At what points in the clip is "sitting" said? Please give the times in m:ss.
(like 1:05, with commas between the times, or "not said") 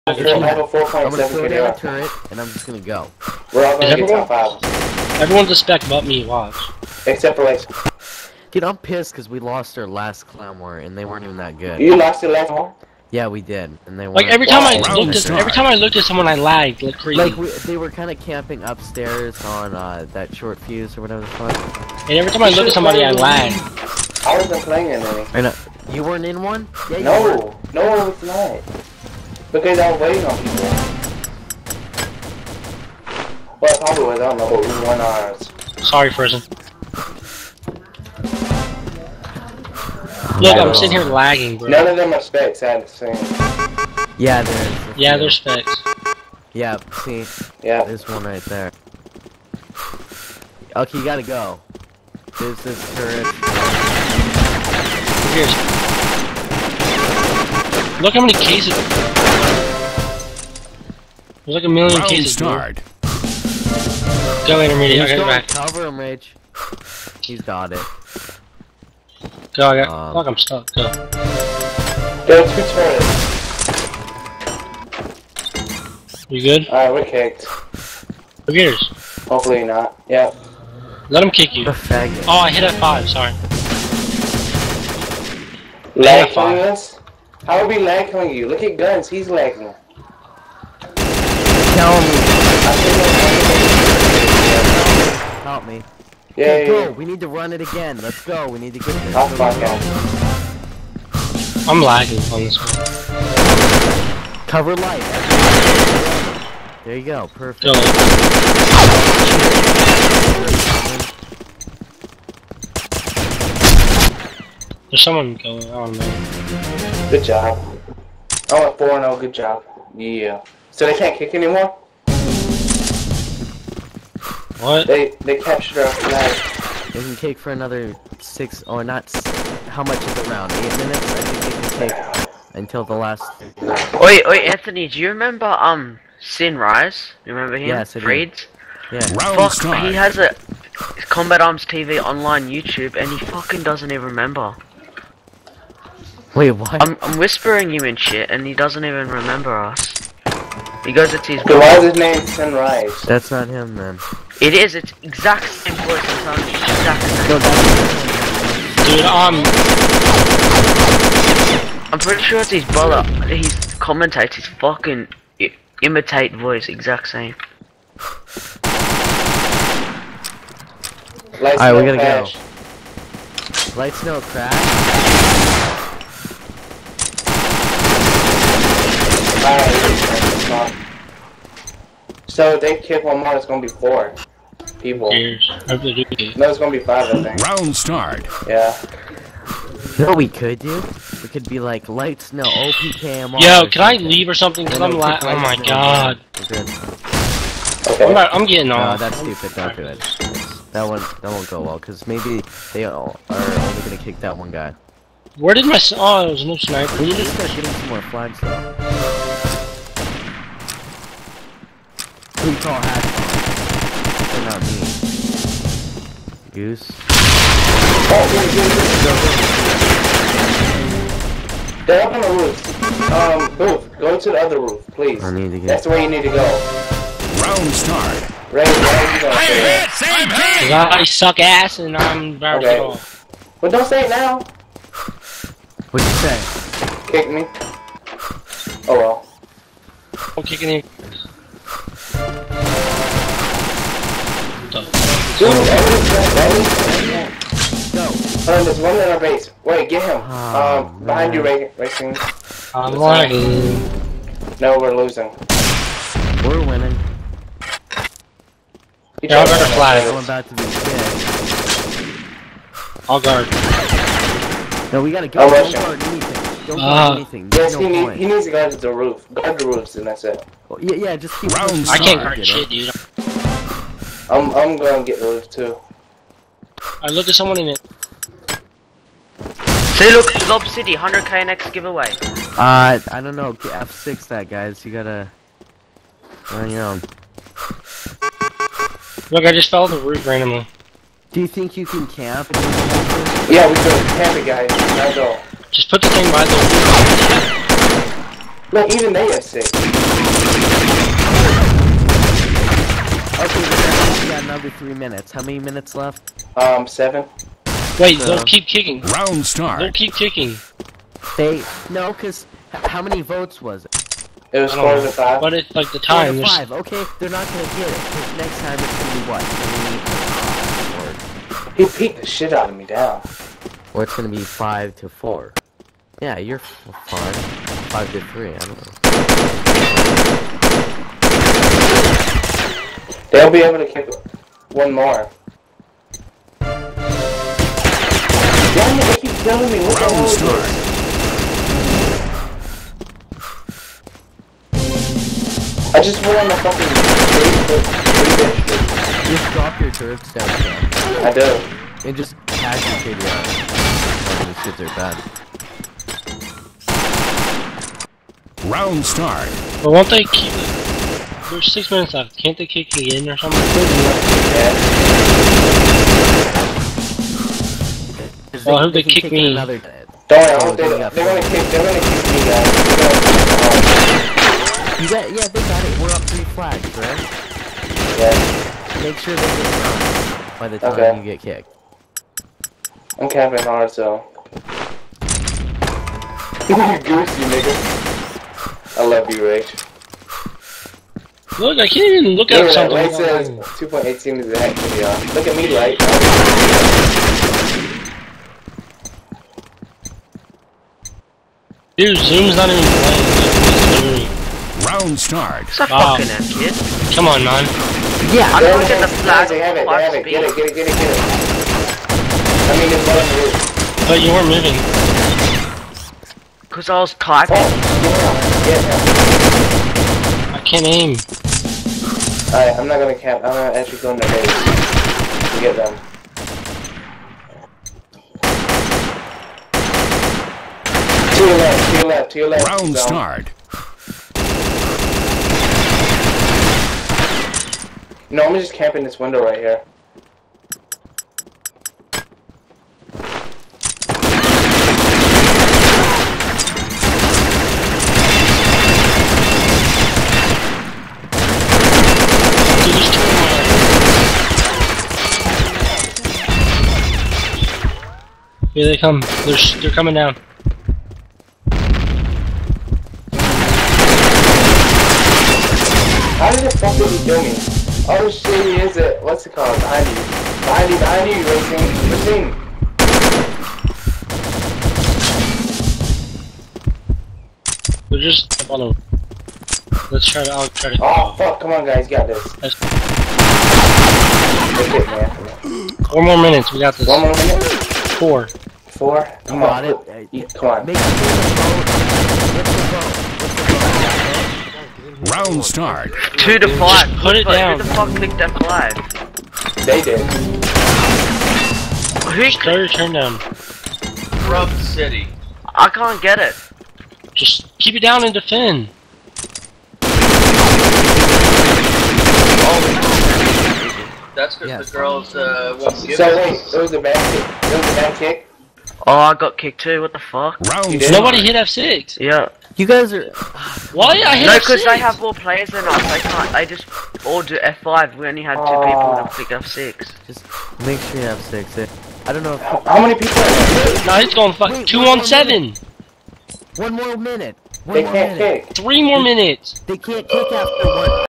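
0:40.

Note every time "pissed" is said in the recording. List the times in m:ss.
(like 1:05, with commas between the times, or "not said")
0:08.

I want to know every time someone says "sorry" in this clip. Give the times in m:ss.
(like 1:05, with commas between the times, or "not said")
0:35, 1:23.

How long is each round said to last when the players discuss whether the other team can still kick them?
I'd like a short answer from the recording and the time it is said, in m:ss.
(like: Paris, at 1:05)
8 minutes, at 2:10.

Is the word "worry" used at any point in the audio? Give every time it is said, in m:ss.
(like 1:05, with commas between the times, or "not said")
6:09.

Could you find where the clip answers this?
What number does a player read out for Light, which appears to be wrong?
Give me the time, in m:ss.
6:33.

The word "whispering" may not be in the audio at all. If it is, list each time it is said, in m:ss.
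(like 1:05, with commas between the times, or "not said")
2:27.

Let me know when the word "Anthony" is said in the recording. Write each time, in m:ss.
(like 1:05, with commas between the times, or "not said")
2:14.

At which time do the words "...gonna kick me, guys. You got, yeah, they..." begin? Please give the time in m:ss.
6:11.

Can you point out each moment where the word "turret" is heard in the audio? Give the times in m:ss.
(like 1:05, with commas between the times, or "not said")
0:01, 0:52, 5:49.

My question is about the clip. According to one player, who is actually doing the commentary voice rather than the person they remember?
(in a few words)
his brother.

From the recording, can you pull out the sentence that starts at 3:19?
No, that's stupid, don't do it.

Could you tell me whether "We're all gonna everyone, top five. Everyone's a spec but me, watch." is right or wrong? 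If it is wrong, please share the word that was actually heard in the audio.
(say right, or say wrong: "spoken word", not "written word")
right.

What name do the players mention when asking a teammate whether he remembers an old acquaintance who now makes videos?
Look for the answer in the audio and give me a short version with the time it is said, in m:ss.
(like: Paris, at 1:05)
Sin Rise, at 2:16.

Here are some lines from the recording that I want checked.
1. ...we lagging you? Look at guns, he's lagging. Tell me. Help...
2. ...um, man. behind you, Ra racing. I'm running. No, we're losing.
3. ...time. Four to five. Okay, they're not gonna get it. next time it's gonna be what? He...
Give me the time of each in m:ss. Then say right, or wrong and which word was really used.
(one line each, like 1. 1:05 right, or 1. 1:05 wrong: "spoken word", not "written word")
1. 1:27 right
2. 4:10 right
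3. 5:15 right.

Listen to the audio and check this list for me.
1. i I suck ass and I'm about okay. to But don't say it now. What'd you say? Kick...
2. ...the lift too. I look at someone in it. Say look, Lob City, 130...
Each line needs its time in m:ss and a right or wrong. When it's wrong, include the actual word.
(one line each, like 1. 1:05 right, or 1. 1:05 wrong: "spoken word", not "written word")
1. 3:50 right
2. 4:35 wrong: "100", not "130".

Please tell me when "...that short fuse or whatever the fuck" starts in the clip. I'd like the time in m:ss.
0:20.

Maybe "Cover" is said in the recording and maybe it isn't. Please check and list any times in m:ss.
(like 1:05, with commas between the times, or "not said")
1:05, 1:44.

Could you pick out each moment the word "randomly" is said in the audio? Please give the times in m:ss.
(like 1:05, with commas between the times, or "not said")
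4:50.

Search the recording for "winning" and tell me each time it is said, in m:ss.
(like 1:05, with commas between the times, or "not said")
4:16.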